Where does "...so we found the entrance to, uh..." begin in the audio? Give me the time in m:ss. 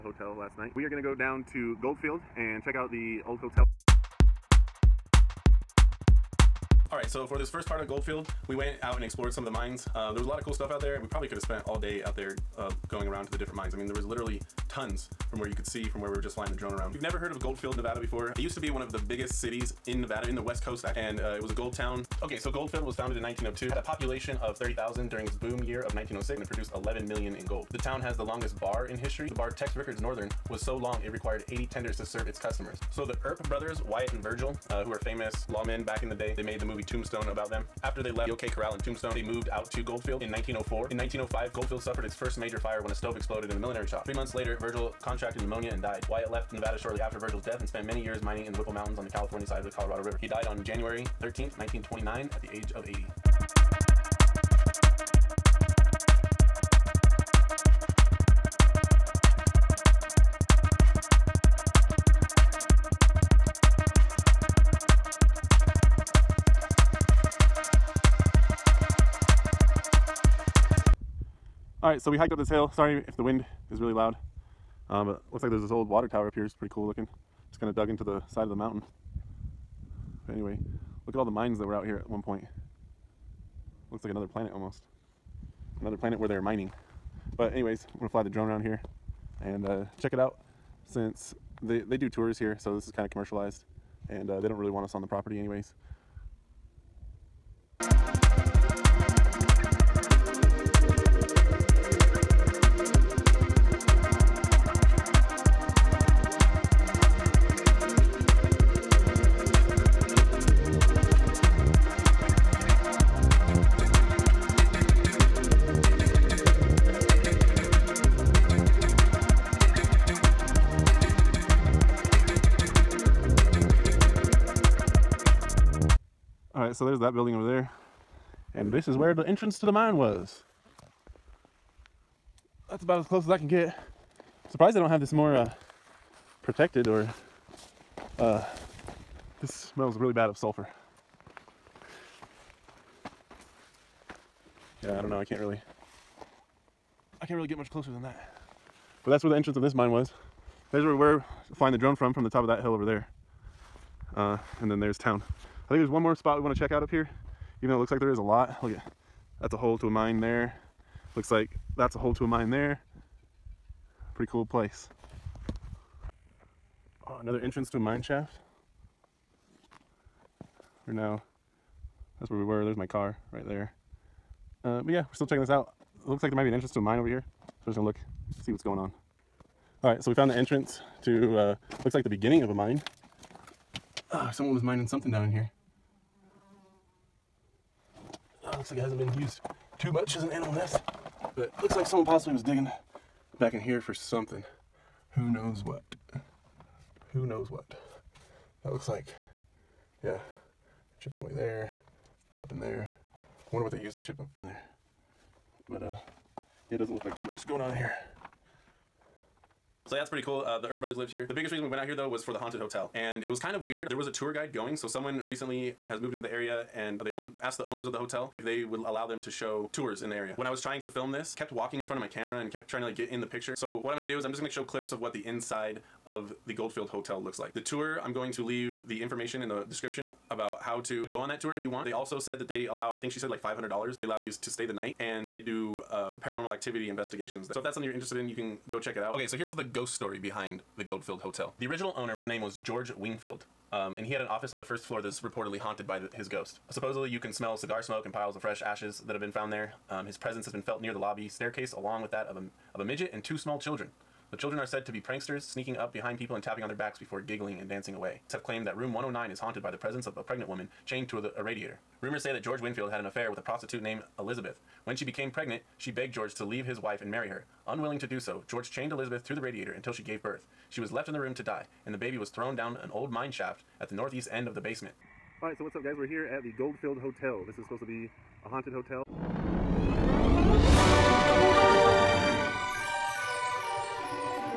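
3:00.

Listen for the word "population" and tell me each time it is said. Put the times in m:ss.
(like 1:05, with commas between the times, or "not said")
0:23.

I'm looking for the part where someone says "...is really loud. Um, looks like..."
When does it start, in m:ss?
1:13.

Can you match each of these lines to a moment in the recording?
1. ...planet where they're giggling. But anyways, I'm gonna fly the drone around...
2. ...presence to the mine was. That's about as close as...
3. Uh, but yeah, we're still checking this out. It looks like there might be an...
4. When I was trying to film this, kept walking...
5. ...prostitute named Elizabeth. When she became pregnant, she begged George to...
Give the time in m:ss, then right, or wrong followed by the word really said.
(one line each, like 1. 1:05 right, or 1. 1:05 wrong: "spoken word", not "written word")
1. 1:25 wrong: "mining", not "giggling"
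2. 2:09 wrong: "entrance", not "presence"
3. 2:54 right
4. 3:40 right
5. 4:23 right.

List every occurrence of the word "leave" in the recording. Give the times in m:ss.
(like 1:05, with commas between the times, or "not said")
3:48, 4:26.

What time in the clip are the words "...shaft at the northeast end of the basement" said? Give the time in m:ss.
4:33.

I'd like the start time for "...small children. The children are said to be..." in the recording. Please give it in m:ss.
4:13.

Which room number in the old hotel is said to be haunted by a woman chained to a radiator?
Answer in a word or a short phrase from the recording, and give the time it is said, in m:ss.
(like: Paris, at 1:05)
109, at 4:18.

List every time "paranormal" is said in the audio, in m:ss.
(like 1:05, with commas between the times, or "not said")
3:56.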